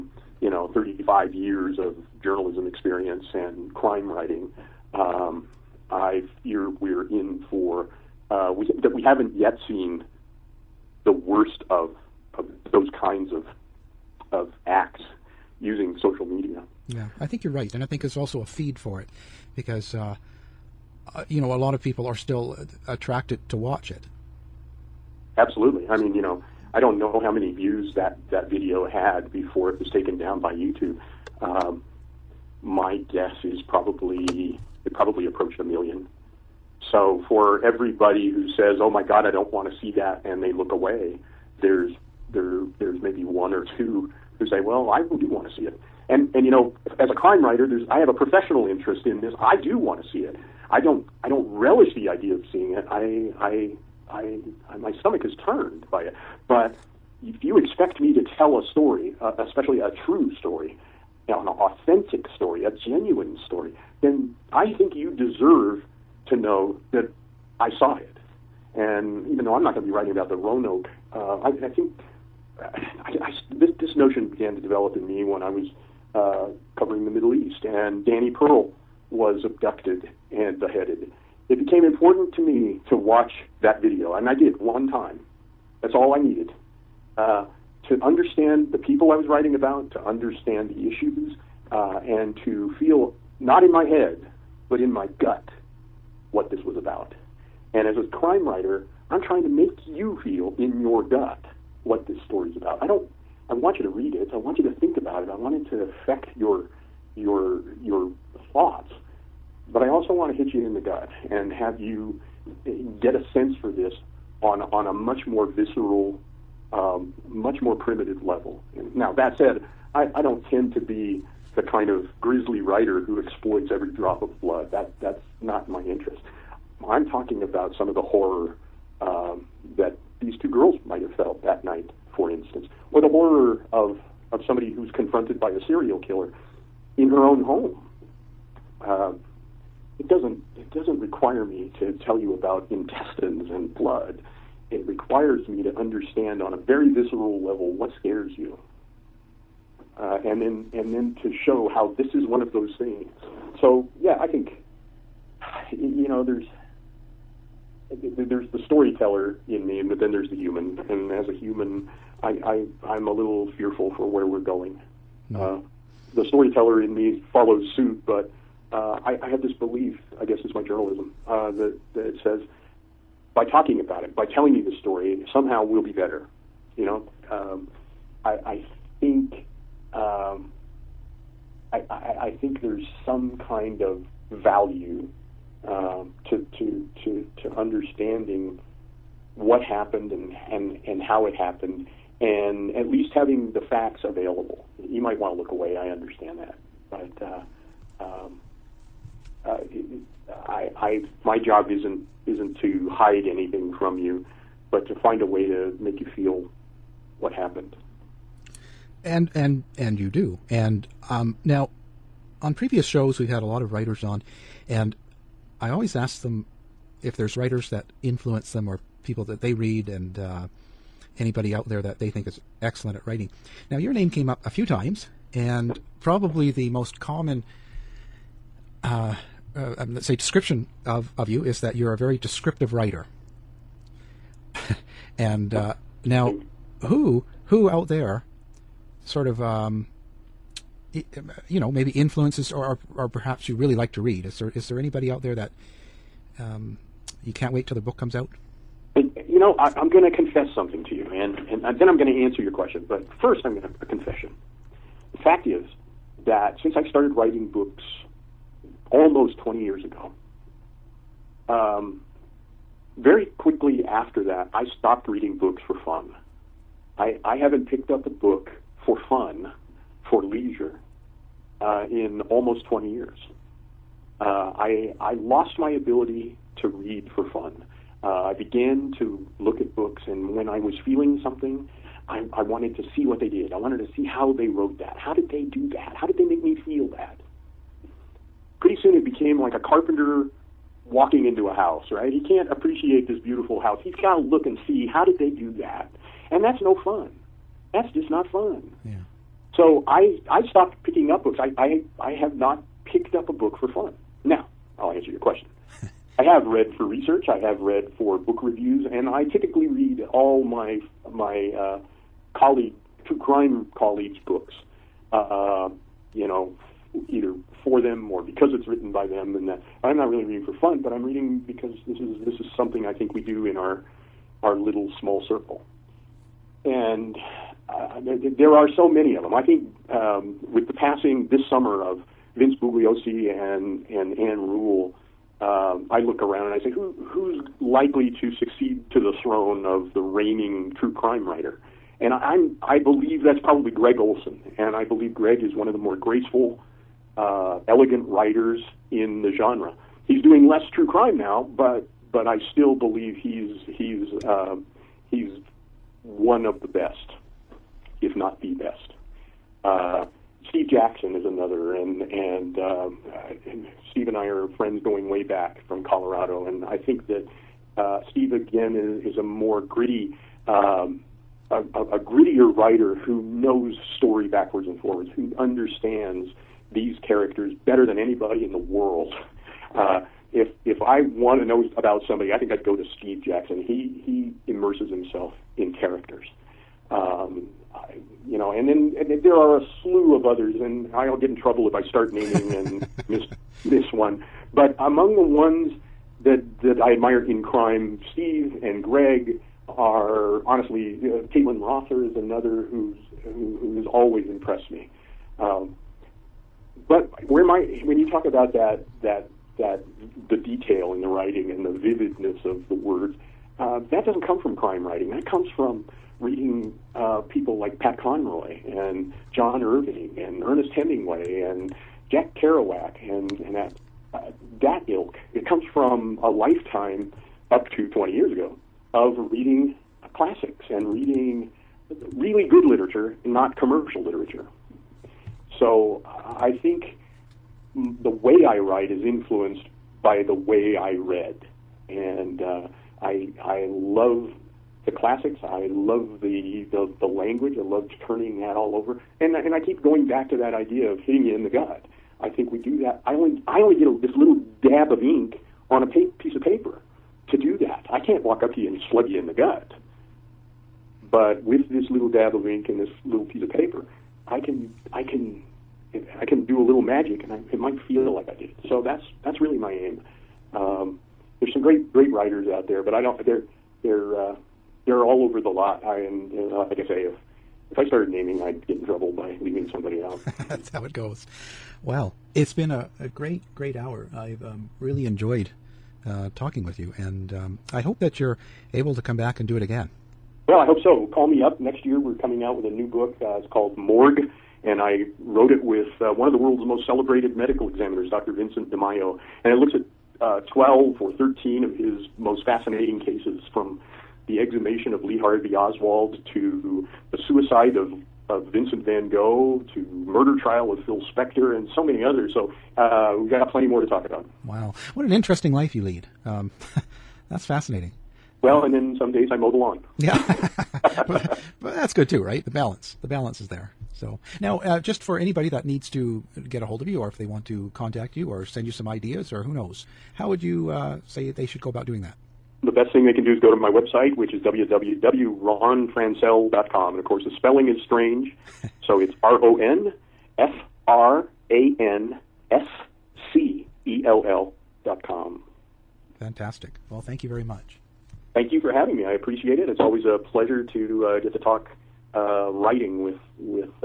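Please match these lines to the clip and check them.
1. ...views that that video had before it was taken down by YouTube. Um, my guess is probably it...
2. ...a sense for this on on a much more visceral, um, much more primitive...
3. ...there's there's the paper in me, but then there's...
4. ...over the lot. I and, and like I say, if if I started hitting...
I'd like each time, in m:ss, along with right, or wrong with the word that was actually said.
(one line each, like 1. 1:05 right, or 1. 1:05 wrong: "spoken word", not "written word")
1. 0:27 right
2. 1:53 right
3. 2:36 wrong: "storyteller", not "paper"
4. 7:55 wrong: "naming", not "hitting".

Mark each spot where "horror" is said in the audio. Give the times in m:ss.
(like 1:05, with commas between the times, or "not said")
2:08, 2:13.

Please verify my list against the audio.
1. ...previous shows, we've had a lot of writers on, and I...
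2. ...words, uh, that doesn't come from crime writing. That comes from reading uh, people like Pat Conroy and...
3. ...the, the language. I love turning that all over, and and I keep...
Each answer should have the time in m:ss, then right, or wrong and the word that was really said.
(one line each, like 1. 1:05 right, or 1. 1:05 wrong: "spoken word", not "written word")
1. 3:32 right
2. 6:52 right
3. 7:26 right.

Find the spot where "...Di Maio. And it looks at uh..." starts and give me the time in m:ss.
8:18.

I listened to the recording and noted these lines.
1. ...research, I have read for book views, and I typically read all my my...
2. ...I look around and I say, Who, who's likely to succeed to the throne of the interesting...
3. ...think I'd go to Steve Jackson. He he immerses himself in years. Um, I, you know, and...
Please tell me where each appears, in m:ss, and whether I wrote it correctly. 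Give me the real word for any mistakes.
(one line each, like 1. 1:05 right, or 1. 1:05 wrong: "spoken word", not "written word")
1. 5:06 wrong: "reviews", not "views"
2. 5:35 wrong: "reigning", not "interesting"
3. 6:22 wrong: "characters", not "years".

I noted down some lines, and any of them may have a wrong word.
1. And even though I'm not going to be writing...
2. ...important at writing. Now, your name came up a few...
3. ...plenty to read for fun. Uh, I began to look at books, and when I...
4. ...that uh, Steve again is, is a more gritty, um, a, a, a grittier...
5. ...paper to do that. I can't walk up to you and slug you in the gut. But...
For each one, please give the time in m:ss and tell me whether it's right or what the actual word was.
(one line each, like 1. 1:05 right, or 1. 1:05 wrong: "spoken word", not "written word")
1. 1:08 right
2. 3:42 wrong: "excellent", not "important"
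3. 4:35 wrong: "ability", not "plenty"
4. 6:07 right
5. 7:36 right.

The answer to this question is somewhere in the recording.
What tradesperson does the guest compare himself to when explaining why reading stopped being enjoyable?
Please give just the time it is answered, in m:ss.
4:49.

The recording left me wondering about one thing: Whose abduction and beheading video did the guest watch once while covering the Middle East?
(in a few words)
Danny Pearl.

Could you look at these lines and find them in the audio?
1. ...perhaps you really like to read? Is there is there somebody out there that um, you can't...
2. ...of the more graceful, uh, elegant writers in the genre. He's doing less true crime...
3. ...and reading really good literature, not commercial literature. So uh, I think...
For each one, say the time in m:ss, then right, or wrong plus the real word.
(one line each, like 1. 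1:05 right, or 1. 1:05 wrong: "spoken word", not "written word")
1. 4:03 wrong: "anybody", not "somebody"
2. 5:45 right
3. 7:10 right.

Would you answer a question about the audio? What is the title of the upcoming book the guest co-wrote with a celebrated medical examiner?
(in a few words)
Morgue.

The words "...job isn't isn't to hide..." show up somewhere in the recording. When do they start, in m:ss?
3:21.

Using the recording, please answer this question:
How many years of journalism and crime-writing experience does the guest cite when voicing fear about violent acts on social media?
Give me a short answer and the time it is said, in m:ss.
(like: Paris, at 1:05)
35, at 0:00.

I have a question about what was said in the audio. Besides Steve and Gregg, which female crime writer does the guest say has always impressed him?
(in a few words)
Caitlin Rother.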